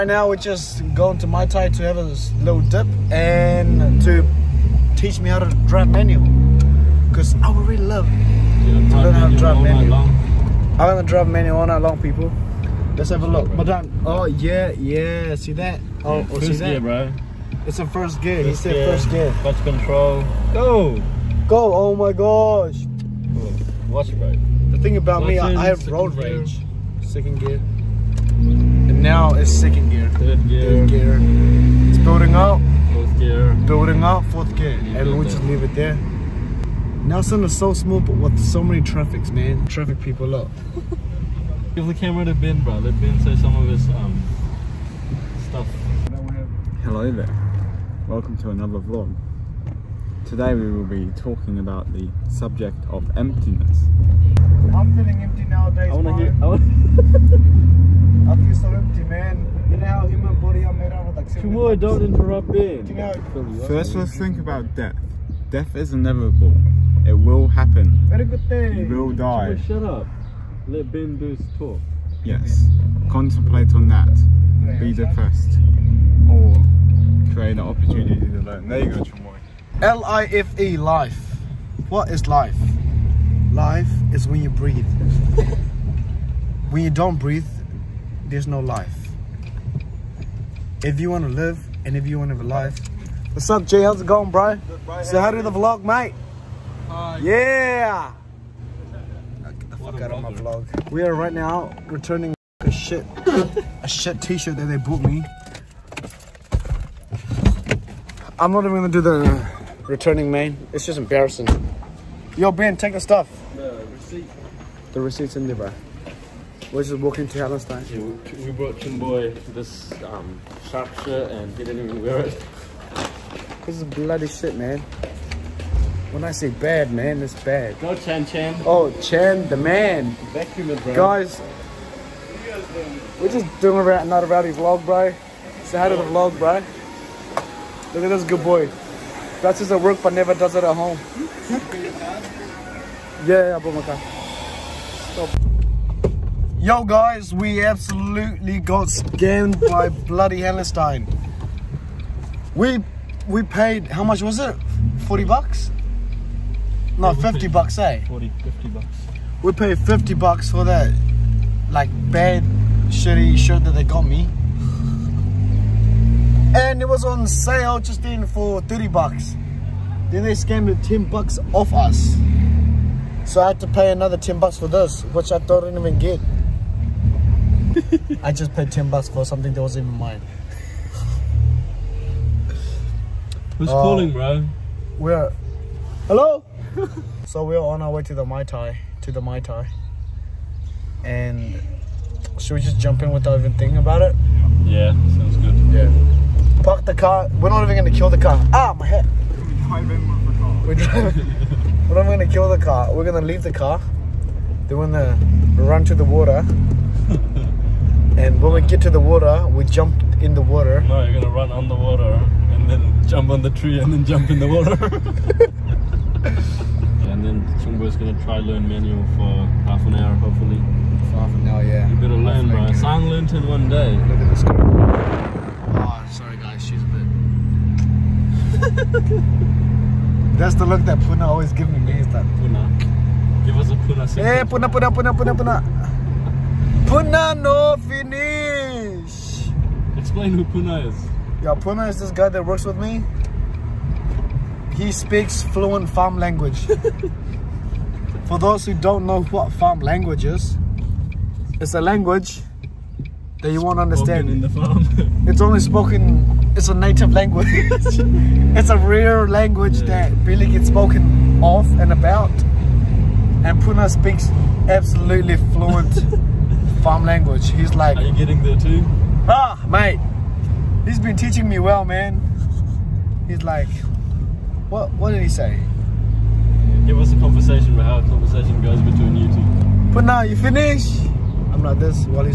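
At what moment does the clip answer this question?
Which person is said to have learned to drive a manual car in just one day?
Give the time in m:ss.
3:42.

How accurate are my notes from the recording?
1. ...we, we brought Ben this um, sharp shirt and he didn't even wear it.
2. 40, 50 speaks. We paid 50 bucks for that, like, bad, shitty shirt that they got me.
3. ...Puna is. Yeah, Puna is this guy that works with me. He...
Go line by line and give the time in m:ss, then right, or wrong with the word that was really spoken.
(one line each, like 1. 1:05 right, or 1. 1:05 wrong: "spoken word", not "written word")
1. 1:58 wrong: "Chimboy", not "Ben"
2. 2:38 wrong: "bucks", not "speaks"
3. 4:00 right.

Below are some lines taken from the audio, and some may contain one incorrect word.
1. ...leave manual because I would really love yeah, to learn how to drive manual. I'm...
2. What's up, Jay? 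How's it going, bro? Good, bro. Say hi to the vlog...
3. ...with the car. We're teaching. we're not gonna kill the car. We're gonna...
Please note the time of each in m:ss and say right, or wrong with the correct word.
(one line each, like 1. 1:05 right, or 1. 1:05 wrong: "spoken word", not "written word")
1. 0:05 wrong: "drive", not "leave"
2. 1:33 right
3. 3:20 wrong: "driving", not "teaching".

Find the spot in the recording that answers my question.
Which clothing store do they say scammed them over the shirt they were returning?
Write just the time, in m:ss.
2:30.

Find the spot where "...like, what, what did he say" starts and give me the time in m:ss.
4:33.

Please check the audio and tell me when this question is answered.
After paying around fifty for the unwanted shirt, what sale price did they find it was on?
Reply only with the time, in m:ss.
2:48.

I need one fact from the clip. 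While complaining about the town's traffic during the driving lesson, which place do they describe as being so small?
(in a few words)
Nelson.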